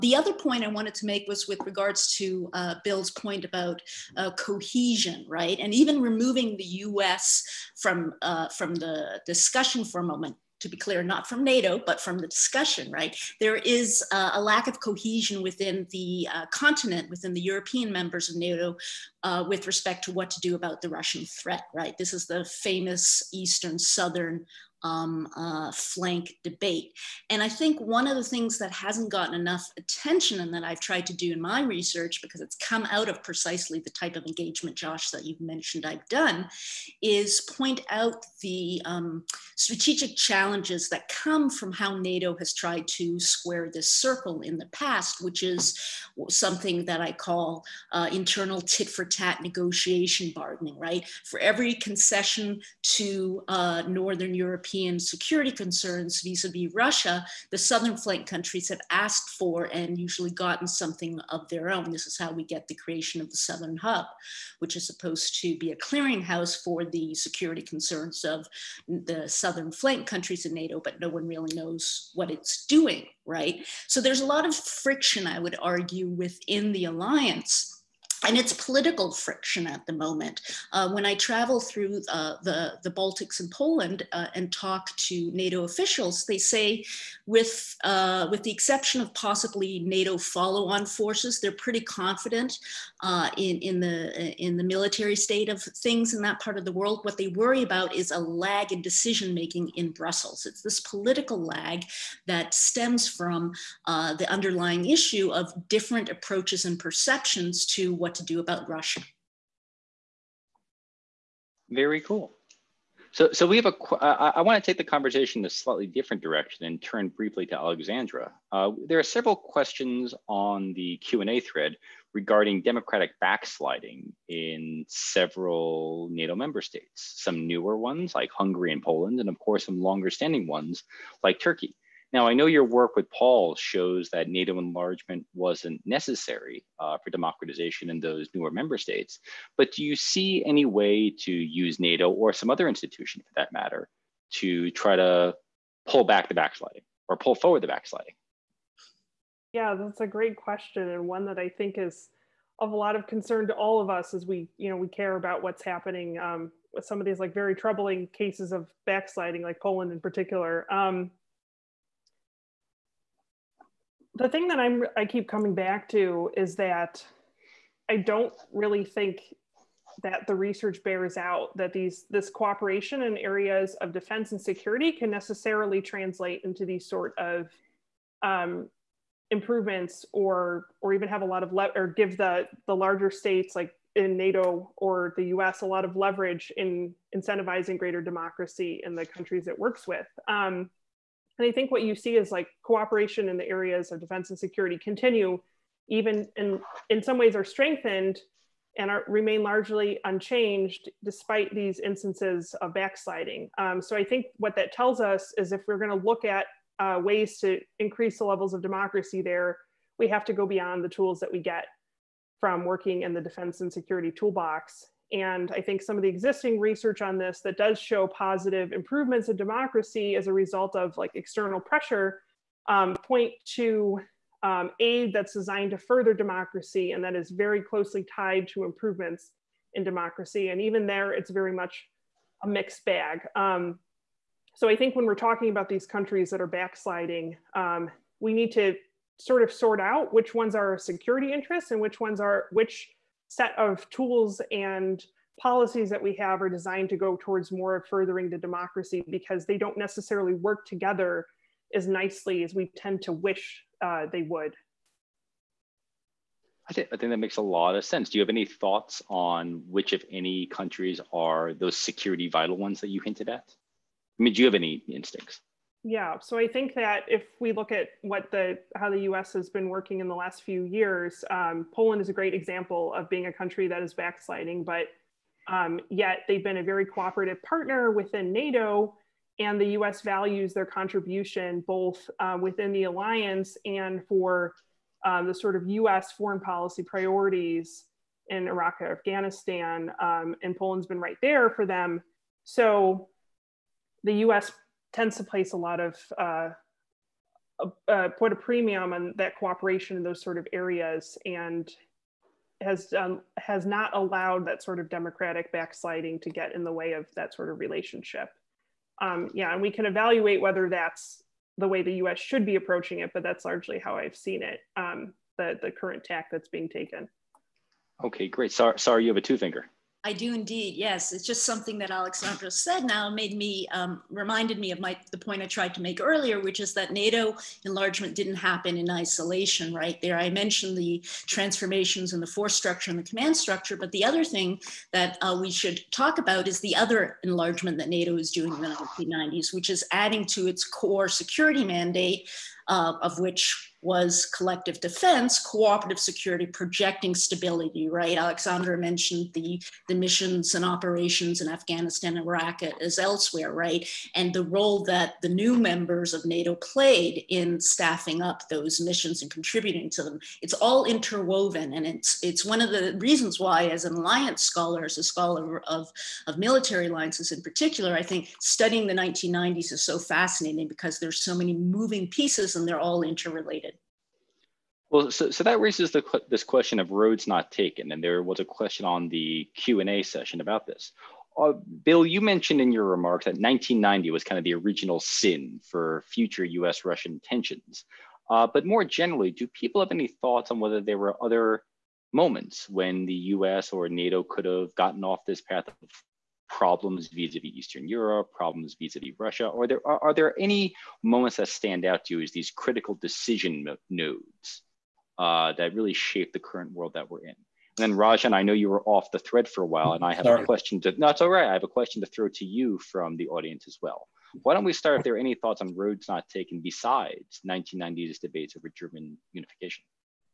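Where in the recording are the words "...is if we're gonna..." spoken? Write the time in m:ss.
3:25.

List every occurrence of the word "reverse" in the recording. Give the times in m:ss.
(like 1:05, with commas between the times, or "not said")
not said.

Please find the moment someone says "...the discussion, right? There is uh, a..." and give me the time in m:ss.
0:12.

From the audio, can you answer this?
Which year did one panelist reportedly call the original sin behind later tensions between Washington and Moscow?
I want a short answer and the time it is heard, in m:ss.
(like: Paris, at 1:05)
1990, at 6:23.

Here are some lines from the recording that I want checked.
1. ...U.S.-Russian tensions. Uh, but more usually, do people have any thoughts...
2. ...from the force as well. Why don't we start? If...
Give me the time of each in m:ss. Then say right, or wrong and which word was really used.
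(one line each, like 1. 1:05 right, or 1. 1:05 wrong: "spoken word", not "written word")
1. 6:26 wrong: "generally", not "usually"
2. 6:52 wrong: "audience", not "force".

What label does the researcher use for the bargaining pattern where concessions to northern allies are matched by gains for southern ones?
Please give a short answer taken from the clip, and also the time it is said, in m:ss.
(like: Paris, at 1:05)
internal tit for tat, at 0:48.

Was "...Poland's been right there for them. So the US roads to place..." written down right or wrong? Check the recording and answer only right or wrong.
wrong.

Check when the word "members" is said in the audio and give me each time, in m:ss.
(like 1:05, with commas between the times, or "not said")
0:17, 2:06, 2:18, 5:55.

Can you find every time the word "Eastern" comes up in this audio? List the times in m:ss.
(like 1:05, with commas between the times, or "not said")
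0:23, 6:37.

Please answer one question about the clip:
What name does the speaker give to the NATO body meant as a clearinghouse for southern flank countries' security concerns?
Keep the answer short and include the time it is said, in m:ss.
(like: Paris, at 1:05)
Southern Hub, at 1:03.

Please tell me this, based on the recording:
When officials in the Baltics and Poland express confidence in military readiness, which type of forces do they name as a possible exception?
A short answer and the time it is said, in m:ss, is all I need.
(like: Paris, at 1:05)
NATO follow on forces, at 1:29.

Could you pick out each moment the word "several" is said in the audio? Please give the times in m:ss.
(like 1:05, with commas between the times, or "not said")
1:59, 2:04.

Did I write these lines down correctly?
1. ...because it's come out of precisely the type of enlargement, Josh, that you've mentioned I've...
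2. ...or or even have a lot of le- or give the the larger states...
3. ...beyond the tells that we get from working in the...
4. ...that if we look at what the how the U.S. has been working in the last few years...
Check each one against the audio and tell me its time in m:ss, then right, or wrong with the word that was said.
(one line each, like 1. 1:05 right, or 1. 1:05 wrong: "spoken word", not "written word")
1. 0:32 wrong: "engagement", not "enlargement"
2. 3:00 right
3. 3:30 wrong: "tools", not "tells"
4. 4:26 right.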